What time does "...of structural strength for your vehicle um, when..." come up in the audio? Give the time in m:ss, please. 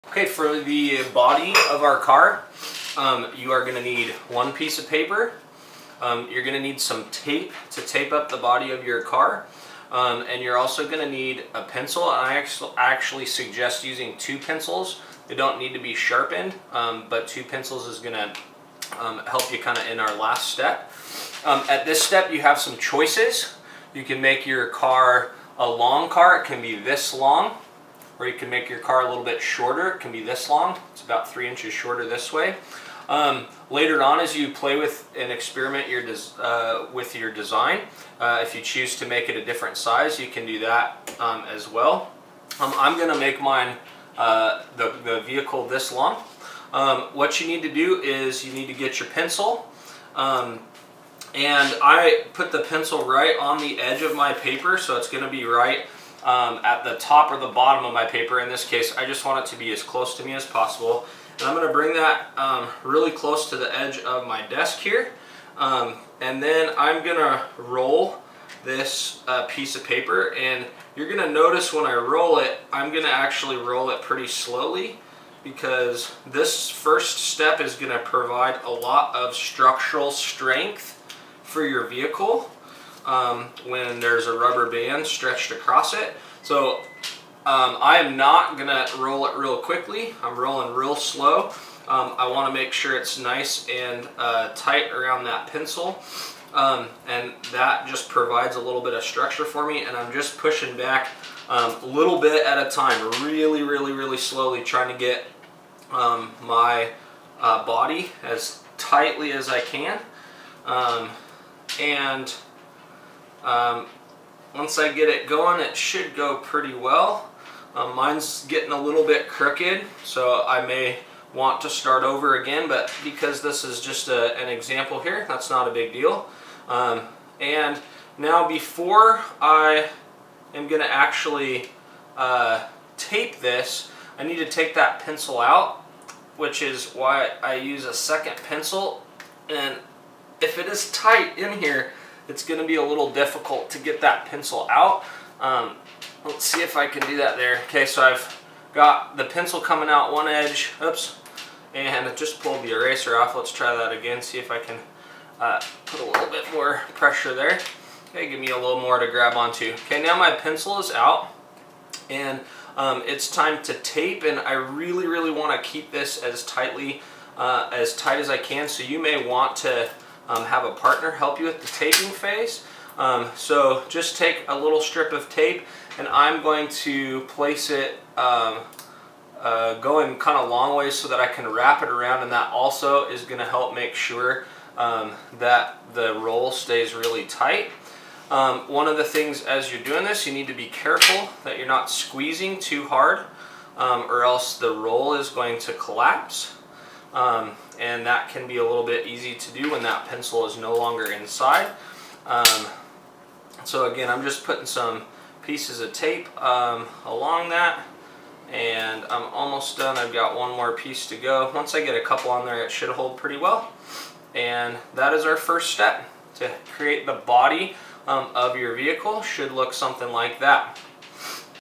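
1:19.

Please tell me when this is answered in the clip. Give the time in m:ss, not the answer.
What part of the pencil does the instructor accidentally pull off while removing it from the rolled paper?
2:32.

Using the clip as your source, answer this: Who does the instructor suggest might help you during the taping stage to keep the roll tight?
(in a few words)
a partner.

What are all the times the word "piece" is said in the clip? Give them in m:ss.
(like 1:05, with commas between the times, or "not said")
0:04, 1:09, 3:25, 3:30.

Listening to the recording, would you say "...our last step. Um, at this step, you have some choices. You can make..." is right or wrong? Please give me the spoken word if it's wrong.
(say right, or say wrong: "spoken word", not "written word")
right.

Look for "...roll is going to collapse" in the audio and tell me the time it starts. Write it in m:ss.
3:14.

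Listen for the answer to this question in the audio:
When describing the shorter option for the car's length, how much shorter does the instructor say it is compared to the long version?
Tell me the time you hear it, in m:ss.
0:31.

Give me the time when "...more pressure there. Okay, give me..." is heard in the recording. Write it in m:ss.
2:36.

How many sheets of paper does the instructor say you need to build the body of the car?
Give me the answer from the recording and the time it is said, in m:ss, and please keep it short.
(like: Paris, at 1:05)
1, at 0:04.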